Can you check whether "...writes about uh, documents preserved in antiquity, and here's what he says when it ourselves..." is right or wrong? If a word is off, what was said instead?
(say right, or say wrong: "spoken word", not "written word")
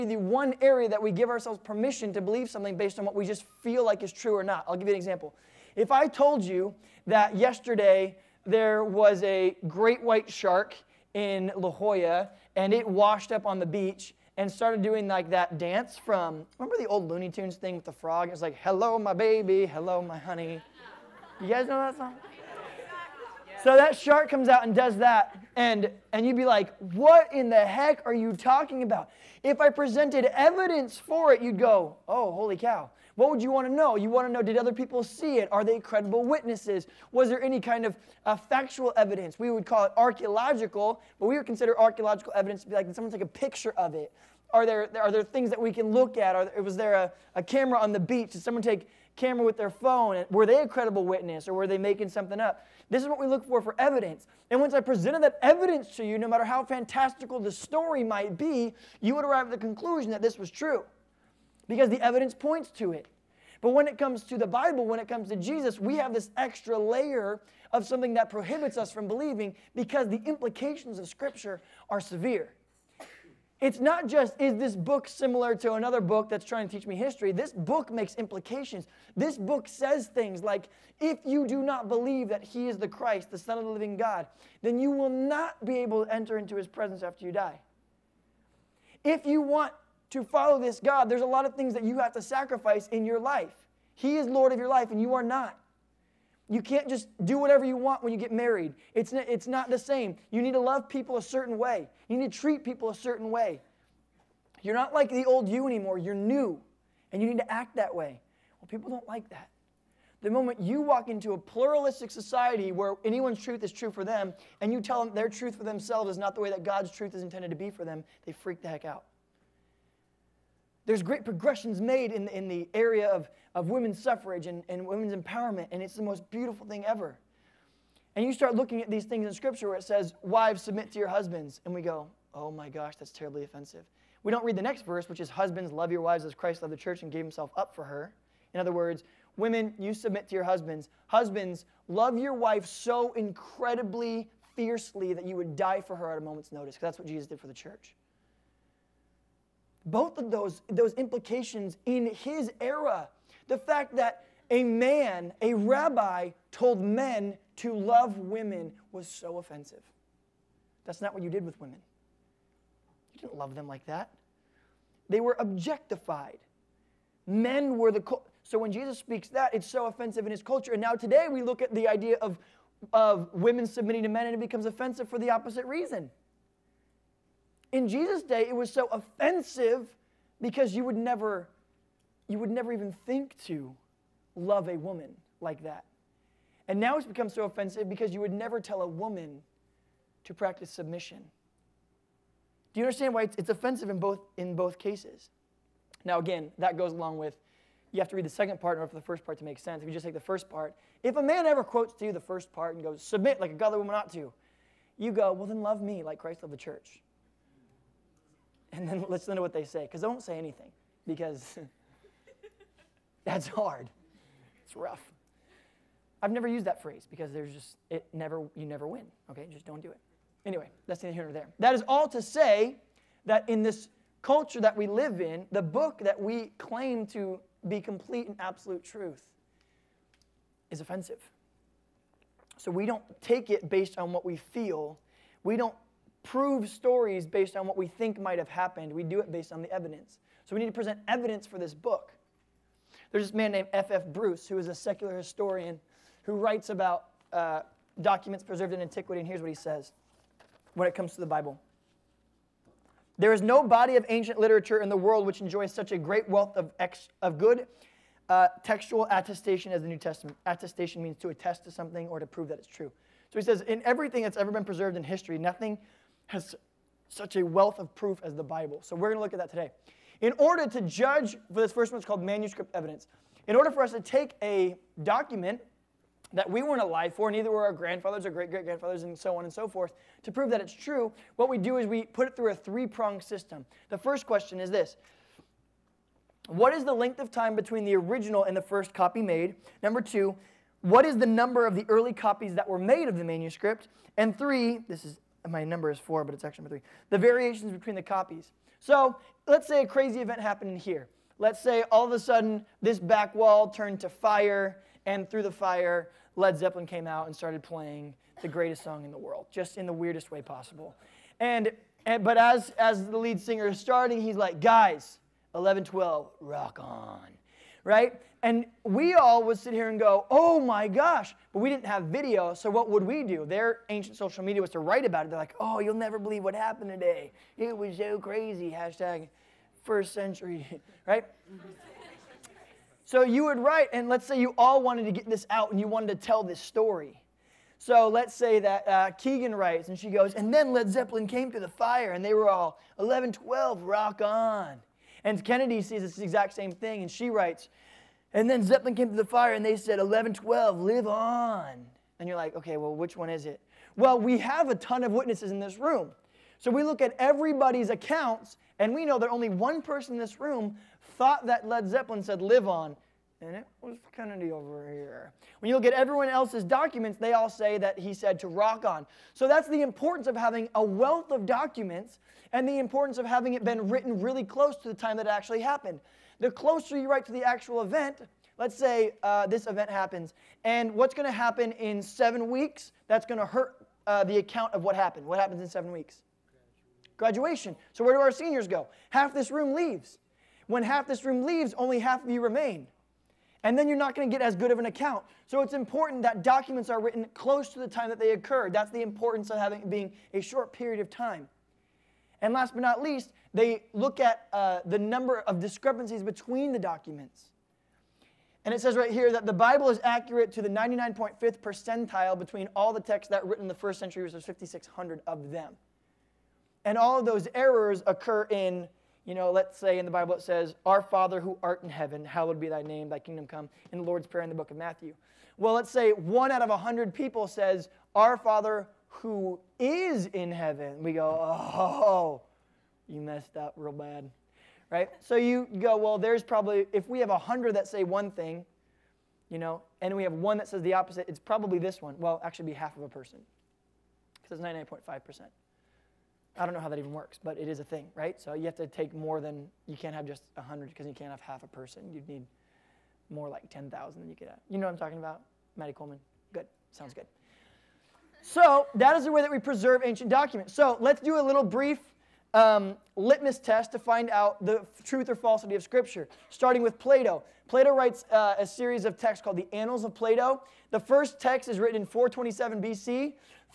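wrong: "comes", not "ourselves".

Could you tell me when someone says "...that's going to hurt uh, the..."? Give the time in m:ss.
6:23.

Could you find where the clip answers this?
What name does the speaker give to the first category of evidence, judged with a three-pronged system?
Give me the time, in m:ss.
4:32.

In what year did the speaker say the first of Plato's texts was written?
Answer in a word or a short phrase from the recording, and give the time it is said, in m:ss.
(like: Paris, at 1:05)
427 BC, at 7:52.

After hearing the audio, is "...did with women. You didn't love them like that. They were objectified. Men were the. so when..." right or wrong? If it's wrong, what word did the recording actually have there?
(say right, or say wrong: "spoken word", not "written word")
right.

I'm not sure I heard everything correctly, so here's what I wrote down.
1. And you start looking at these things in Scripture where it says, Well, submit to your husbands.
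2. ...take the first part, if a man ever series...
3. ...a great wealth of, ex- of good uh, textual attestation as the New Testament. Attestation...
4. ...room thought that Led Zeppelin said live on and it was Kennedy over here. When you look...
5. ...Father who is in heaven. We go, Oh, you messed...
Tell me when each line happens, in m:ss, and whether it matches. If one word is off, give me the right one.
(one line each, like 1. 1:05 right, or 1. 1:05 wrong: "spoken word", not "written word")
1. 2:08 wrong: "Wives", not "Well"
2. 3:20 wrong: "quotes", not "series"
3. 4:15 right
4. 6:00 right
5. 7:08 right.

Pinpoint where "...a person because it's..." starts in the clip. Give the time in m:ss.
7:23.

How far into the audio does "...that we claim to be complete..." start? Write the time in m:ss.
3:45.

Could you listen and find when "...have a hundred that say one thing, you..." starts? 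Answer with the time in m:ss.
7:17.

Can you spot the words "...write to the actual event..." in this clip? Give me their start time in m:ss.
6:17.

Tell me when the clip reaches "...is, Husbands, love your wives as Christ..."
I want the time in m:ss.
2:15.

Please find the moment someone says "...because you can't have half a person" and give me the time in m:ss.
7:30.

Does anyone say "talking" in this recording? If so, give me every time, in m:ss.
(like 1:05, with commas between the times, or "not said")
0:28, 7:34.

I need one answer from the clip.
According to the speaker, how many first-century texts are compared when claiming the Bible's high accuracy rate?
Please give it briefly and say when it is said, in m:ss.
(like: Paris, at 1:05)
5,600, at 6:54.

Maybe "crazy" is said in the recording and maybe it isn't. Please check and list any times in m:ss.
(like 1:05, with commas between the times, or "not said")
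4:59, 5:28.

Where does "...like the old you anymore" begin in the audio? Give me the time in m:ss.
1:44.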